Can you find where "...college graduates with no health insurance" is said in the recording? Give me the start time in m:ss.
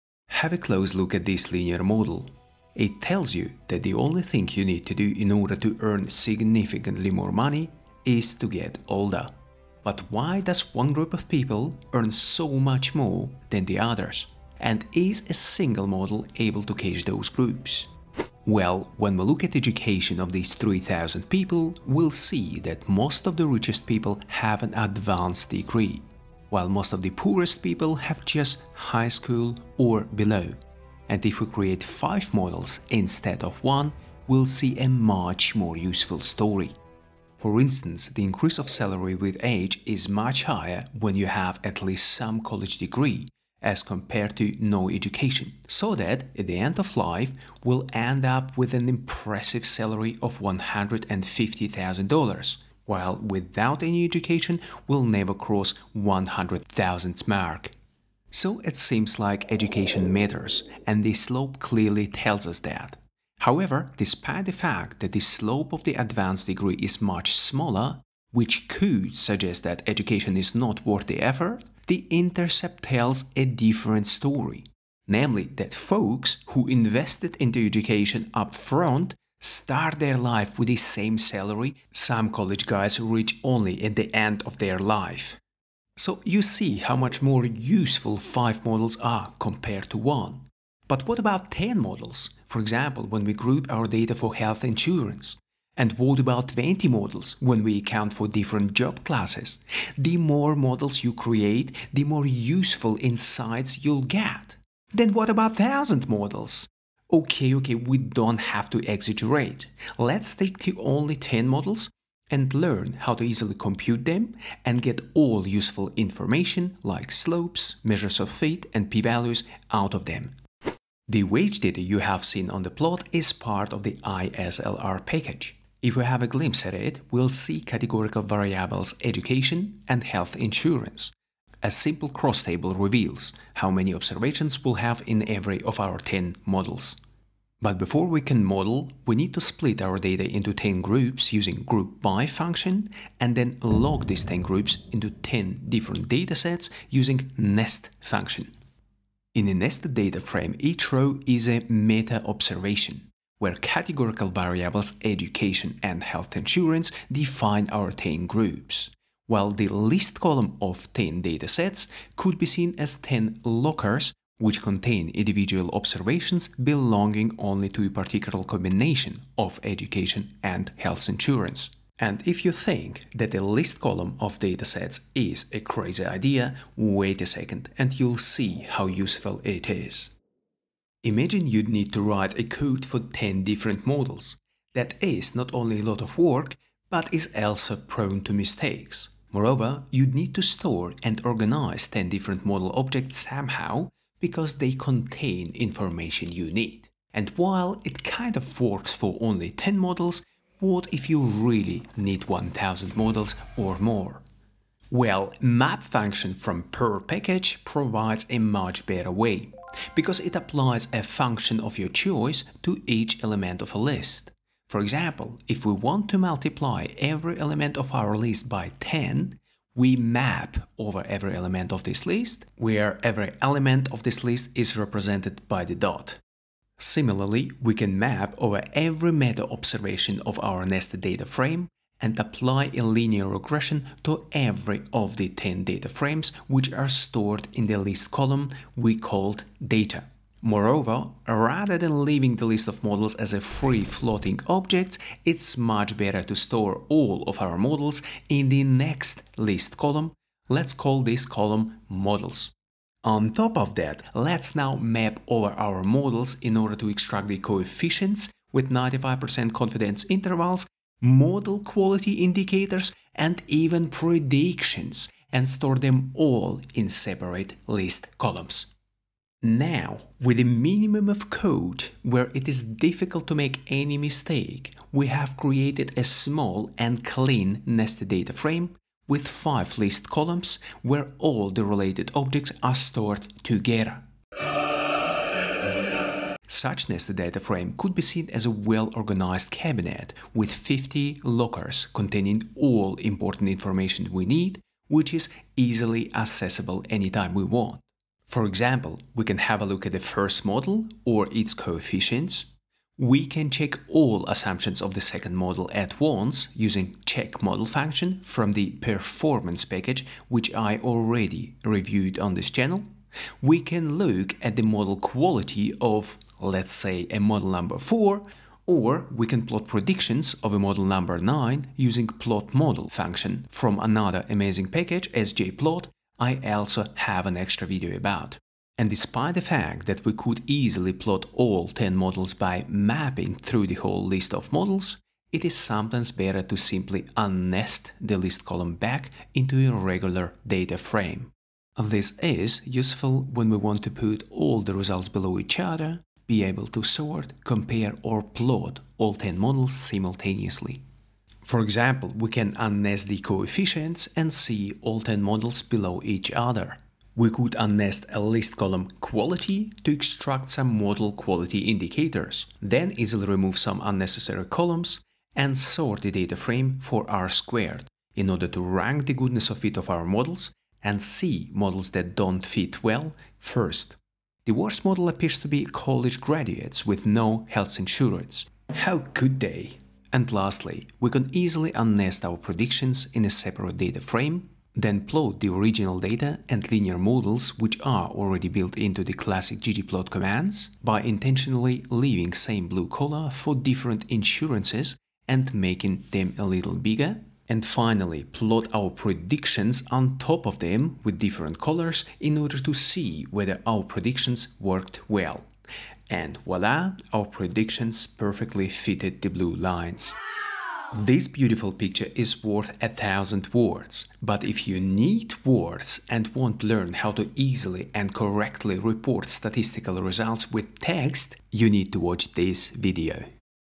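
6:15.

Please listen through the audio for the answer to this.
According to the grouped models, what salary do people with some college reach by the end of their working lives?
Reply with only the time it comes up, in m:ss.
0:50.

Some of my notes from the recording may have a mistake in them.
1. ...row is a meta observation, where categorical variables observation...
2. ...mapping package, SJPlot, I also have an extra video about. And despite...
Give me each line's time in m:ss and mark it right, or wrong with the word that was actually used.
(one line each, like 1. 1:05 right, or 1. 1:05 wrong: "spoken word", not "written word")
1. 2:30 wrong: "education", not "observation"
2. 5:24 wrong: "amazing", not "mapping".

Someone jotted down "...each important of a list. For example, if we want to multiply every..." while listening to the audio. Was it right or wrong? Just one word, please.
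wrong.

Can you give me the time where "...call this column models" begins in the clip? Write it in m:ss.
4:10.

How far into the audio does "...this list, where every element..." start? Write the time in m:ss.
3:41.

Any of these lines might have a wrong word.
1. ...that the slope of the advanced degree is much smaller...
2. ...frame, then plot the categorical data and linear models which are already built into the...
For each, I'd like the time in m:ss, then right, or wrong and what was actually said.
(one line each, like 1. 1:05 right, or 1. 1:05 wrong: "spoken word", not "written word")
1. 1:04 right
2. 6:24 wrong: "original", not "categorical".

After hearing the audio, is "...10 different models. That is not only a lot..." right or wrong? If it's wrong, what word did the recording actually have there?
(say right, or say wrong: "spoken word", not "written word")
right.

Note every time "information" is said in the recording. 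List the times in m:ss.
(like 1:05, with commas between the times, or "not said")
1:55, 3:15, 4:53.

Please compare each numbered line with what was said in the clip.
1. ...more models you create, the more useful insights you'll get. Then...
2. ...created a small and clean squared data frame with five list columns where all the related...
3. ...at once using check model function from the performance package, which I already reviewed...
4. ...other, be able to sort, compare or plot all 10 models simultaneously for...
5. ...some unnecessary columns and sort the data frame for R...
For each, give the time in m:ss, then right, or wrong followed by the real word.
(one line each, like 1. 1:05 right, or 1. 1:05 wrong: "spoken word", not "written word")
1. 1:40 right
2. 4:35 wrong: "nested", not "squared"
3. 5:05 right
4. 5:45 right
5. 6:03 right.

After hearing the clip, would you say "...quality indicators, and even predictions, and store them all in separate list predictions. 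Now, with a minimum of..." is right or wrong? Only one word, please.
wrong.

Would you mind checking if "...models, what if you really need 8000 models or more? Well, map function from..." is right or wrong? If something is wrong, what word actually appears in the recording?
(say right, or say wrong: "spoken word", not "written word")
wrong: "1000", not "8000".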